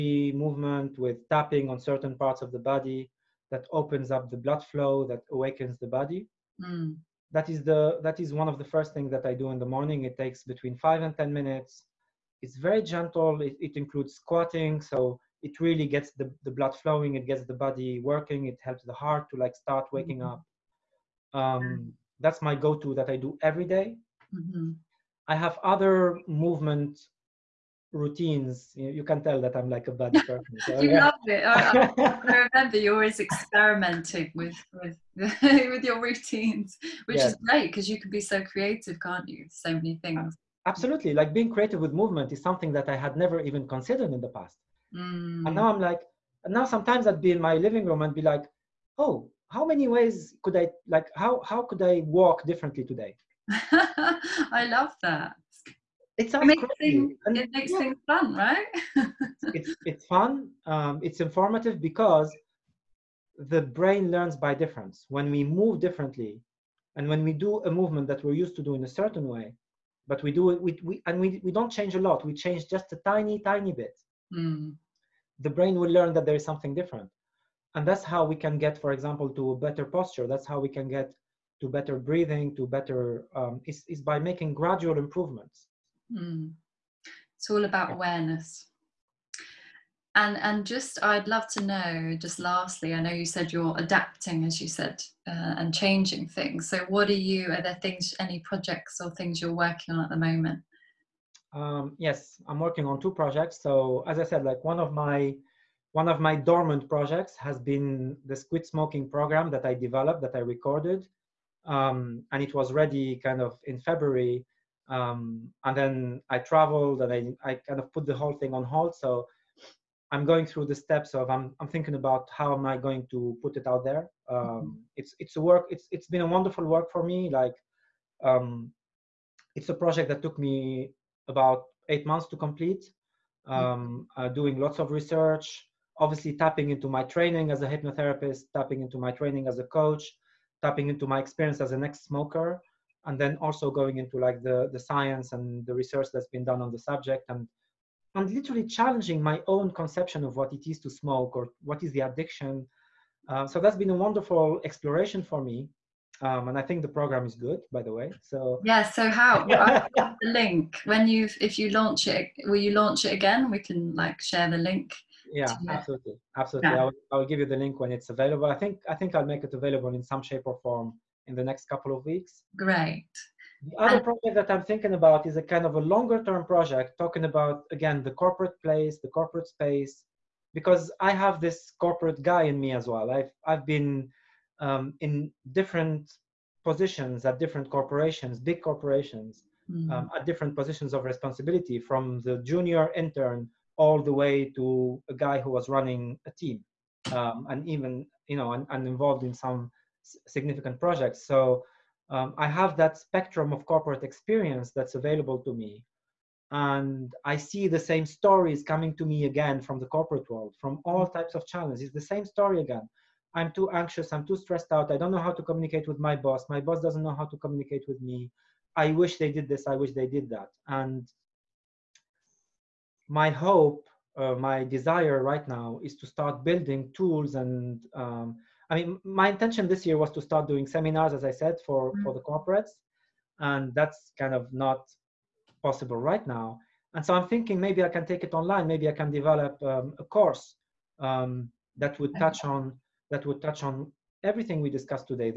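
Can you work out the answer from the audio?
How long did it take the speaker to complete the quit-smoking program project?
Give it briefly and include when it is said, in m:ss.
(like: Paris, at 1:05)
8 months, at 2:11.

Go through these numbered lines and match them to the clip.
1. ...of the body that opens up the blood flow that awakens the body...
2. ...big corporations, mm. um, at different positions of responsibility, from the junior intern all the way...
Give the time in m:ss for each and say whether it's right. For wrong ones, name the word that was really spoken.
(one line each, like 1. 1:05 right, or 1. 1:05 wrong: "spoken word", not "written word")
1. 0:02 right
2. 3:08 right.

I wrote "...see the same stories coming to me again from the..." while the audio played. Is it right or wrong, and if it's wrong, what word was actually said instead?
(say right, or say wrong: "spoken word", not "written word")
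right.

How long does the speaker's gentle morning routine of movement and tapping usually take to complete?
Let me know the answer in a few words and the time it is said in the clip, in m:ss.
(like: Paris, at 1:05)
5 to 10 minutes, at 0:10.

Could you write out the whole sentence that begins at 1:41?
Um, yes, I'm working on two projects.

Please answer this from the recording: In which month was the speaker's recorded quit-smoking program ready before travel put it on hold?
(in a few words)
February.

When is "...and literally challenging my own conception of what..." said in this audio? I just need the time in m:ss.
2:28.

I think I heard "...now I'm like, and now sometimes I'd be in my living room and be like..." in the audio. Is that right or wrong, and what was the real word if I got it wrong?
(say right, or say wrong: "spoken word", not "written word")
right.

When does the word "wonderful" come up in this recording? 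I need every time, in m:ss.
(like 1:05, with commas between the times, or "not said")
2:06, 2:34.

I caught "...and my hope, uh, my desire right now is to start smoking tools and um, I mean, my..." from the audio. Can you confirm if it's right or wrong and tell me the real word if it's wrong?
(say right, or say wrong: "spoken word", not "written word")
wrong: "building", not "smoking".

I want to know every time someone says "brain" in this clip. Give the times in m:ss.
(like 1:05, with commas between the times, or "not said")
1:03, 1:15.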